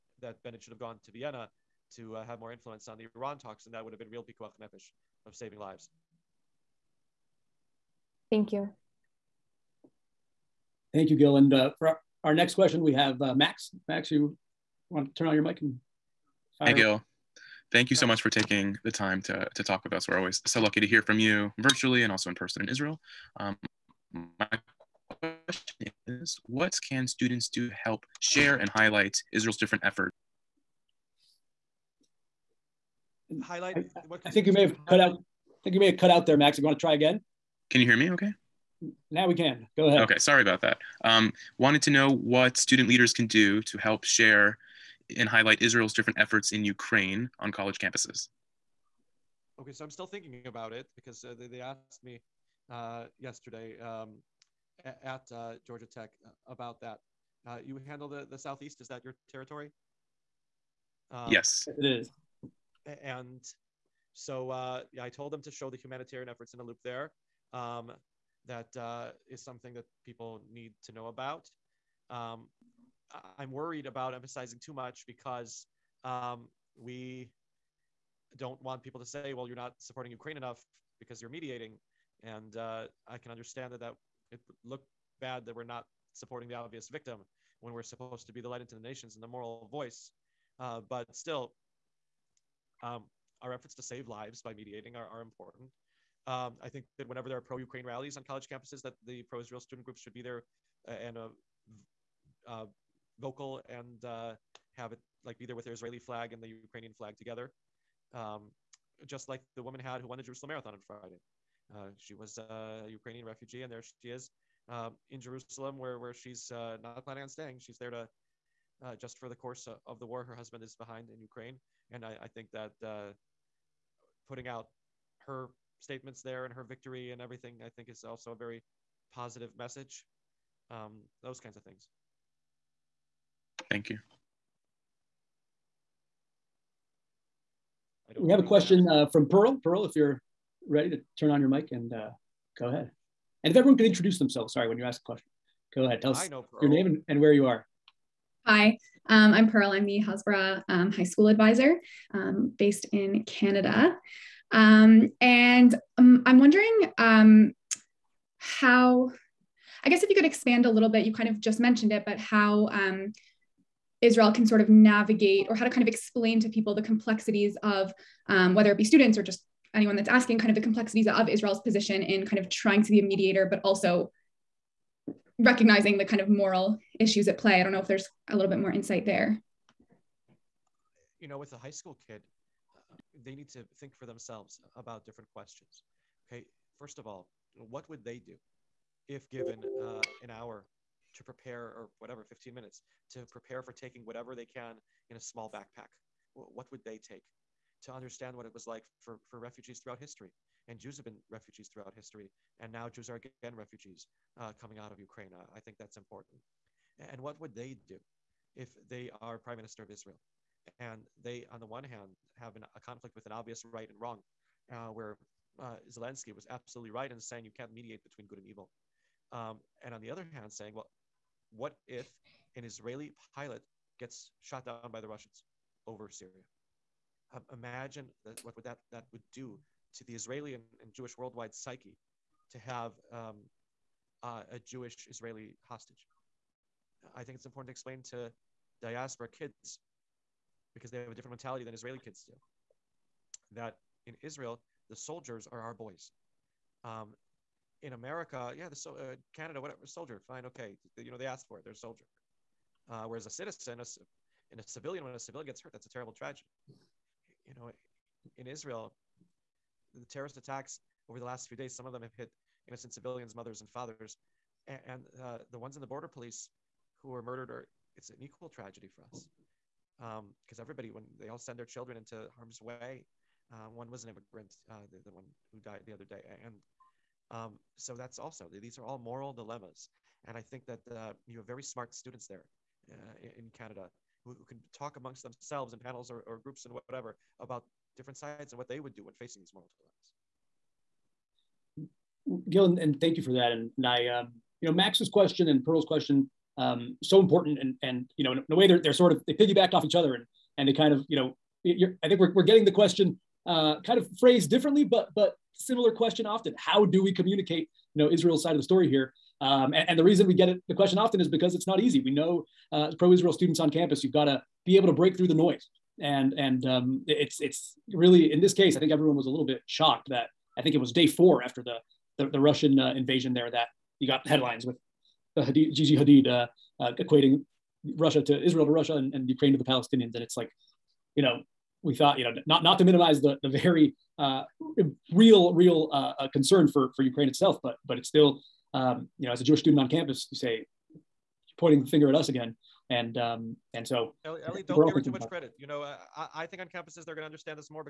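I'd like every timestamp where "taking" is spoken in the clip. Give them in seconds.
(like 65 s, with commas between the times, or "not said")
18 s, 193 s.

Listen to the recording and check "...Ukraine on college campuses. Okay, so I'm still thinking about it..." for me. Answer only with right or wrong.
right.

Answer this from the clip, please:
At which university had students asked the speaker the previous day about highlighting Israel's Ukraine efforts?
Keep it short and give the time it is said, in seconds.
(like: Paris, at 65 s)
Georgia Tech, at 55 s.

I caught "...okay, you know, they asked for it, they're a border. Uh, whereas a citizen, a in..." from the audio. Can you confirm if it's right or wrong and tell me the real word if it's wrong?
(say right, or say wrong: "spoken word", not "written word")
wrong: "soldier", not "border".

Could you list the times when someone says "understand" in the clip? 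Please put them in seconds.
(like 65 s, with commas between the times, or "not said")
83 s, 197 s, 347 s.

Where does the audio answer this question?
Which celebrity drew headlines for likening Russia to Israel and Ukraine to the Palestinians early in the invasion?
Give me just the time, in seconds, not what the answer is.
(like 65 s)
325 s.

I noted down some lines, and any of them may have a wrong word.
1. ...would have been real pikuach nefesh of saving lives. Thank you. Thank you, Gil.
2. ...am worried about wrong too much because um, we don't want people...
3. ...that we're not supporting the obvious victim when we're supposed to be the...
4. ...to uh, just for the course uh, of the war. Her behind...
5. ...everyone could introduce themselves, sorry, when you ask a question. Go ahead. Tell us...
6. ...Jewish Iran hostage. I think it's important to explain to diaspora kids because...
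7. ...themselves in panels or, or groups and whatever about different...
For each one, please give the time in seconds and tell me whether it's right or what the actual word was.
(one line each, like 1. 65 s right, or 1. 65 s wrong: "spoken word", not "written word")
1. 3 s right
2. 73 s wrong: "emphasizing", not "wrong"
3. 85 s right
4. 117 s wrong: "husband", not "behind"
5. 143 s right
6. 234 s wrong: "Israeli", not "Iran"
7. 285 s right.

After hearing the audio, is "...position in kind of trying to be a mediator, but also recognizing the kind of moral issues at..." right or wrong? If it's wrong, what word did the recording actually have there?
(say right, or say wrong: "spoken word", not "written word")
right.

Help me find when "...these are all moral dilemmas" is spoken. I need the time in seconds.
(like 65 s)
278 s.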